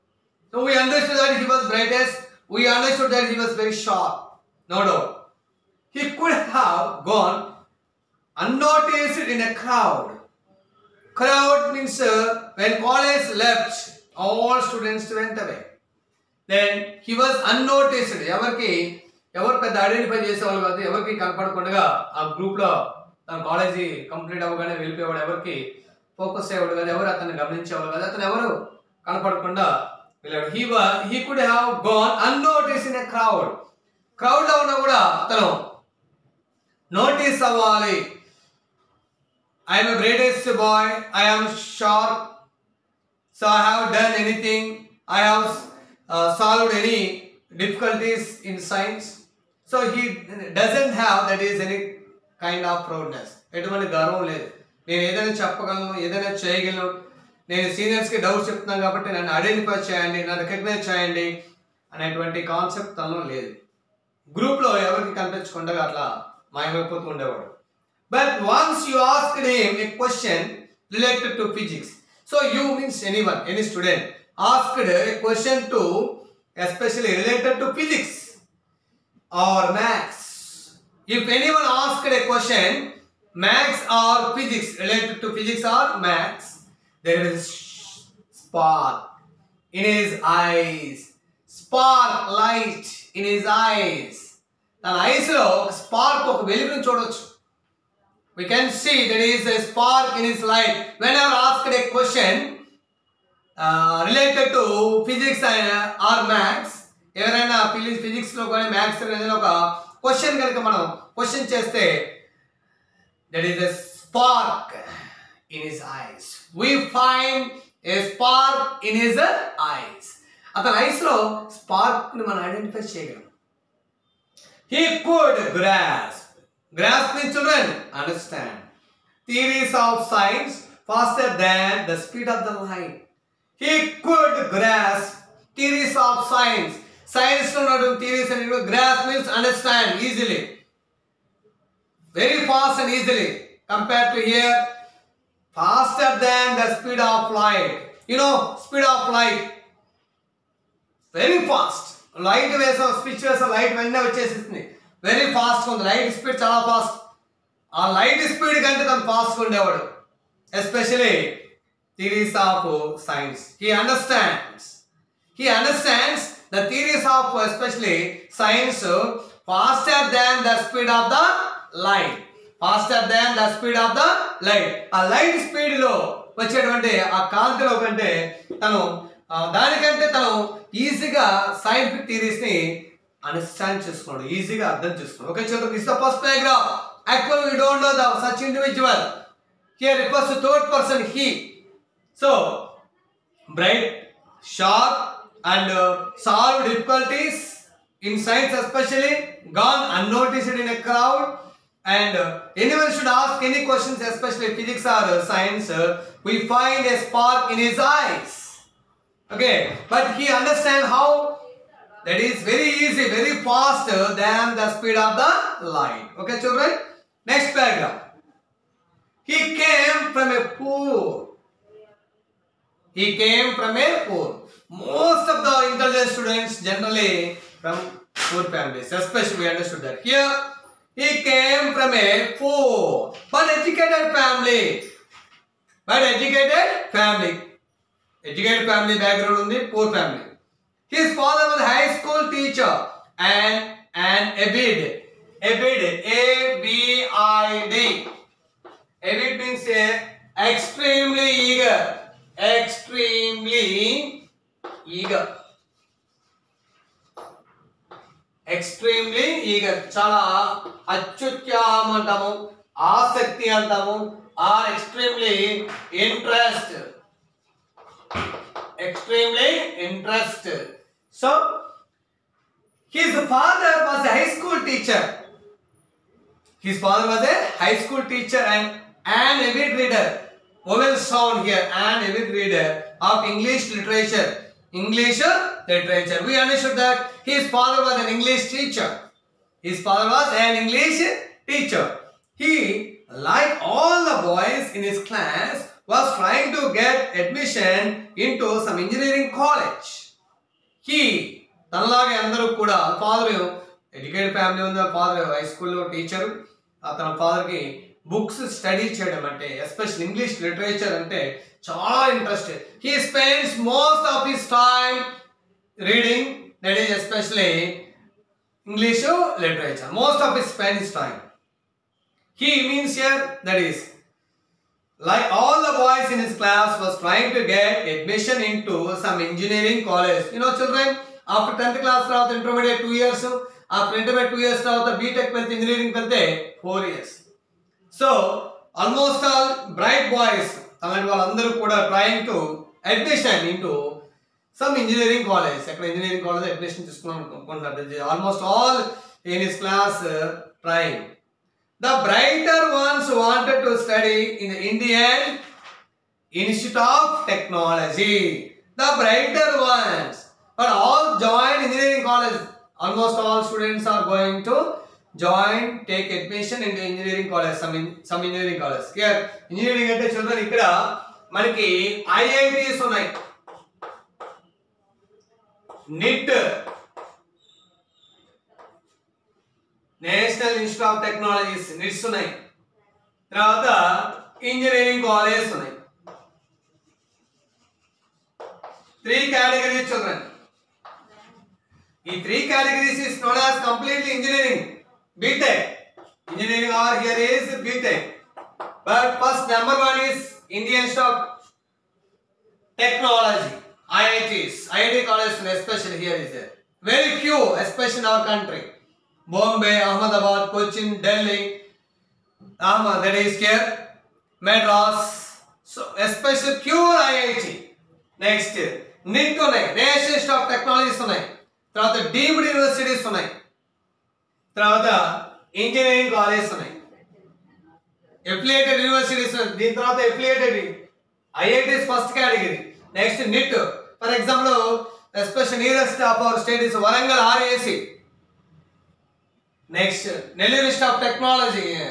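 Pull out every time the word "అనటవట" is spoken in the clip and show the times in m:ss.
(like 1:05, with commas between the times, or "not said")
1:01.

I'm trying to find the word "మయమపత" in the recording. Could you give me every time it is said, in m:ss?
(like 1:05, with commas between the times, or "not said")
1:06.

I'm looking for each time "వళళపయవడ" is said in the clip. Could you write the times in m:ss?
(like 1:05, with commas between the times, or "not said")
0:24.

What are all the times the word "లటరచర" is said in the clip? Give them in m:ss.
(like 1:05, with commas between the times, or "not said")
5:10, 5:19.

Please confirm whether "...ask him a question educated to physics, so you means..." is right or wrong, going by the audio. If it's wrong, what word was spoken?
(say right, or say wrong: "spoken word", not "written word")
wrong: "related", not "educated".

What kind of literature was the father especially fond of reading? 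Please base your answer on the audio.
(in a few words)
English literature.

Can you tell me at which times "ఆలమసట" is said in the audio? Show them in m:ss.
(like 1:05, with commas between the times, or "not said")
5:38, 5:48, 6:02.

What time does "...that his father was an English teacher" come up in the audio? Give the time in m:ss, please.
4:46.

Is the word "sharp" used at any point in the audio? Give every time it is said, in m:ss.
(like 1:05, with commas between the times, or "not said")
0:03, 0:41.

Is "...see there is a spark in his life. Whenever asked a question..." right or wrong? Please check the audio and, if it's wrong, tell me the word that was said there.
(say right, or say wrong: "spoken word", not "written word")
right.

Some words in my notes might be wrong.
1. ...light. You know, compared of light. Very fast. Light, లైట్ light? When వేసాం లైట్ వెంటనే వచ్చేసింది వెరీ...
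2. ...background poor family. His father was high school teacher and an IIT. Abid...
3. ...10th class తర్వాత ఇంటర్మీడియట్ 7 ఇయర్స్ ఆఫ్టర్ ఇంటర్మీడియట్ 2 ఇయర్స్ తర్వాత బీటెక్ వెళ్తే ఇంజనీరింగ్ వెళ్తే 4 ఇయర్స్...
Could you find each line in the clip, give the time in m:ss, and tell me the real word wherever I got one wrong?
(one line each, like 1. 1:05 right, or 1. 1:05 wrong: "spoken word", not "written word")
1. 2:27 wrong: "speed", not "compared"
2. 3:58 wrong: "Abid", not "IIT"
3. 5:31 wrong: "2", not "7".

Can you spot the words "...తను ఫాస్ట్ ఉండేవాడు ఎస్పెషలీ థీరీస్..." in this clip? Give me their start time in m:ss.
2:38.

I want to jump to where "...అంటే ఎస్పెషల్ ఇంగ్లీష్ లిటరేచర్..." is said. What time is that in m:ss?
5:09.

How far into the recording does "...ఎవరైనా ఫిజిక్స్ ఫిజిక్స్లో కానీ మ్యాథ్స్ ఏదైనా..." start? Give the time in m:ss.
1:47.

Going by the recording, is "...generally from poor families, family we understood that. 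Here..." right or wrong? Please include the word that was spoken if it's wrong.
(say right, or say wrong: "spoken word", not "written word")
wrong: "especially", not "family".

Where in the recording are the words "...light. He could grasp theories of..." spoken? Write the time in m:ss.
2:12.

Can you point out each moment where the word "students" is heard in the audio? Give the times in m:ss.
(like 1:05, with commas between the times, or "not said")
0:15, 1:13, 3:46.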